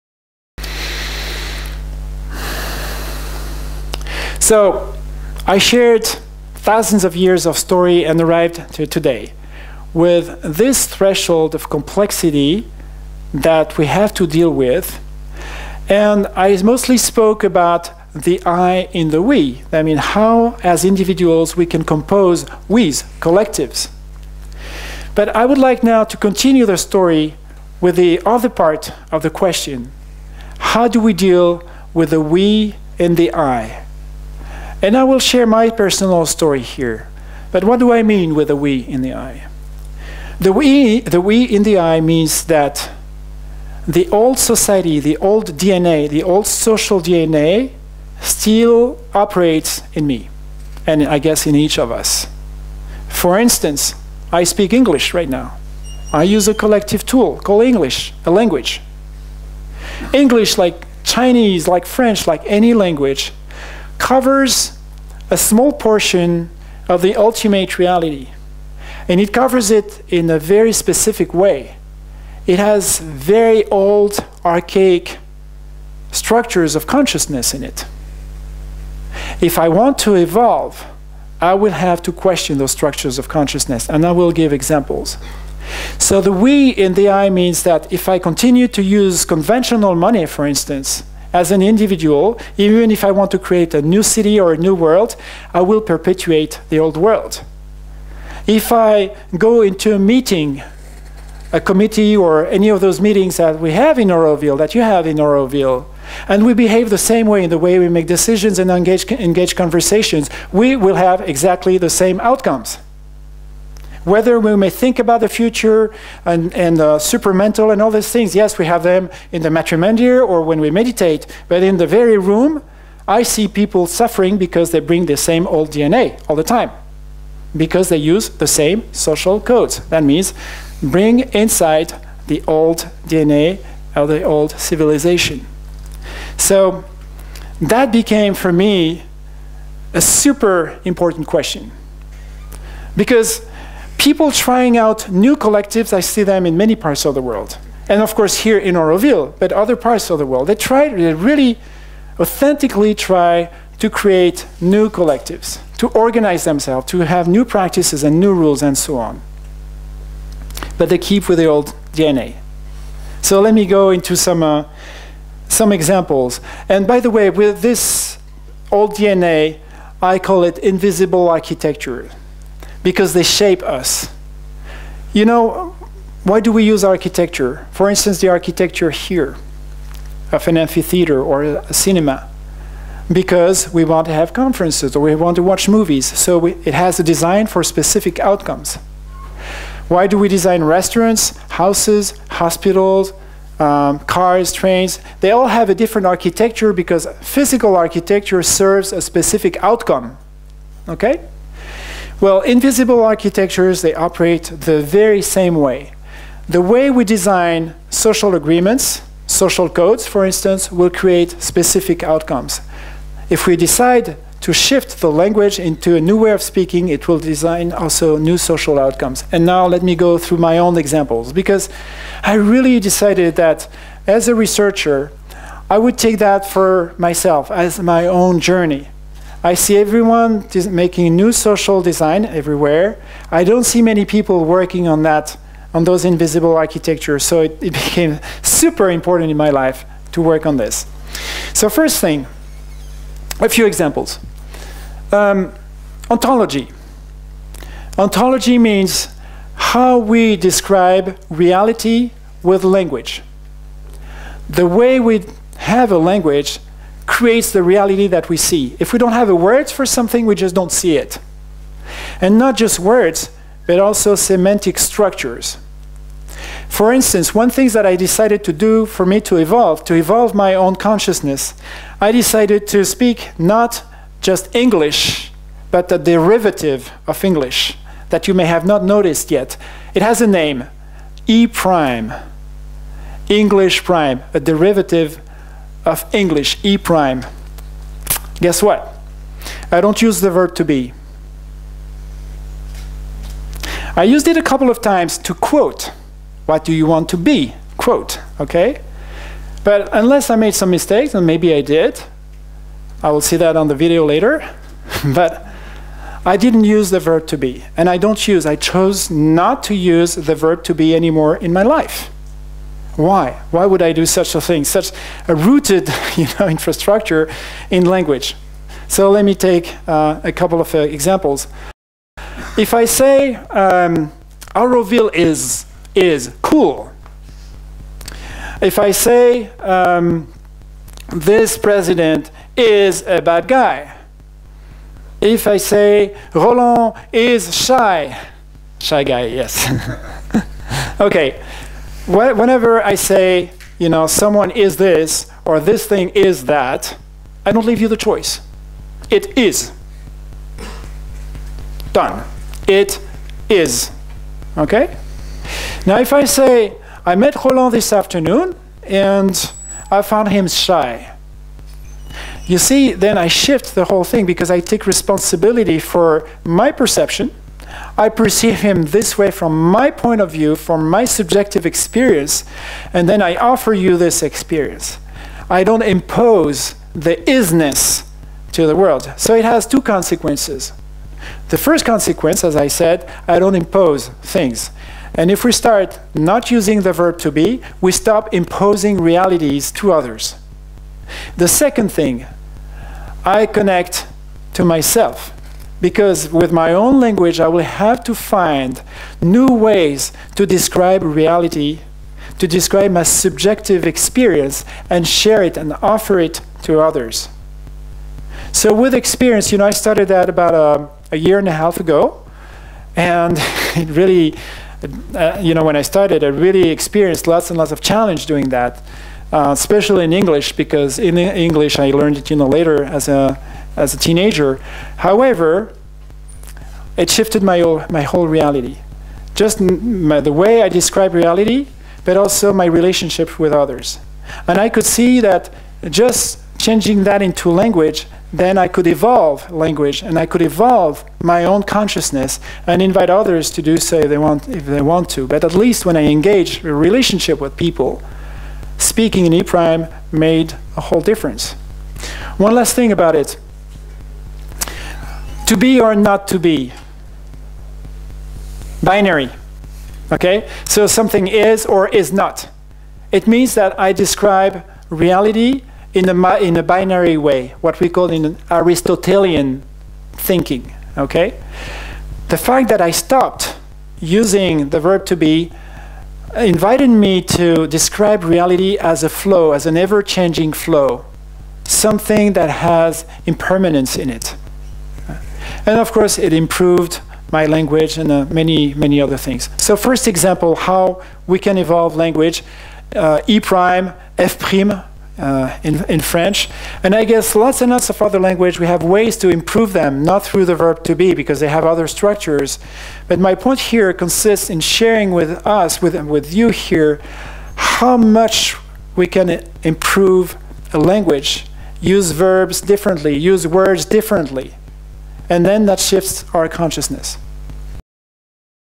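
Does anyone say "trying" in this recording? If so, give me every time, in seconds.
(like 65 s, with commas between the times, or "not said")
144 s.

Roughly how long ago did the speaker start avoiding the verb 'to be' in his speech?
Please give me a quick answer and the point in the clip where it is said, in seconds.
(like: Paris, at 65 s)
a year and a half, at 411 s.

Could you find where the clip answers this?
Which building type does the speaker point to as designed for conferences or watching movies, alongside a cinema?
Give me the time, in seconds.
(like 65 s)
180 s.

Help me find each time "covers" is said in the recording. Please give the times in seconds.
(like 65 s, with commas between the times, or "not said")
64 s, 69 s.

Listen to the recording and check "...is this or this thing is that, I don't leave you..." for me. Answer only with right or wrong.
right.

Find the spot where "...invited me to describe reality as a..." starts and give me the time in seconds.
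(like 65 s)
476 s.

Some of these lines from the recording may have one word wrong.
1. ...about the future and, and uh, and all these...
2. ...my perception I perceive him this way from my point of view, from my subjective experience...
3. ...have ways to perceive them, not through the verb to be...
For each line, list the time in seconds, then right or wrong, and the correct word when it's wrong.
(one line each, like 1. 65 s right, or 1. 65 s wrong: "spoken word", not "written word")
1. 114 s right
2. 366 s right
3. 498 s wrong: "improve", not "perceive".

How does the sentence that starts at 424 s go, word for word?
However, it shifted my whole, my whole reality, just my, the way I describe reality, but also my relationship with others.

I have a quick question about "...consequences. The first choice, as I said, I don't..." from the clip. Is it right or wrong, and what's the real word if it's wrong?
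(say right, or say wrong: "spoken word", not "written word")
wrong: "consequence", not "choice".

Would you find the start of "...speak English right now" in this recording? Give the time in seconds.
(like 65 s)
54 s.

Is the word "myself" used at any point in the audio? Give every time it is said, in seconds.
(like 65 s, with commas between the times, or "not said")
226 s, 394 s.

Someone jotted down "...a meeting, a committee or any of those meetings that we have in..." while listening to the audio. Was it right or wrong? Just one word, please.
right.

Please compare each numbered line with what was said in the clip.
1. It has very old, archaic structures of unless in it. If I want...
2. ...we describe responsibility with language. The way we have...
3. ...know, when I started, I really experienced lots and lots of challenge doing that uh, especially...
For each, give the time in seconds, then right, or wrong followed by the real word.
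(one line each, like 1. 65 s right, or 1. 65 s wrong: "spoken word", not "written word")
1. 72 s wrong: "consciousness", not "unless"
2. 249 s wrong: "reality", not "responsibility"
3. 415 s right.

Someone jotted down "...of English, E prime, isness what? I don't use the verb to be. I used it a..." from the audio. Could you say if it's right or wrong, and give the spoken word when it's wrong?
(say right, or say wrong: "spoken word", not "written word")
wrong: "guess", not "isness".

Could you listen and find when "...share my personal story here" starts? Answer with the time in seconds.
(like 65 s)
35 s.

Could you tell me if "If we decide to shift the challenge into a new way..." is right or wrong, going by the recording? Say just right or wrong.
wrong.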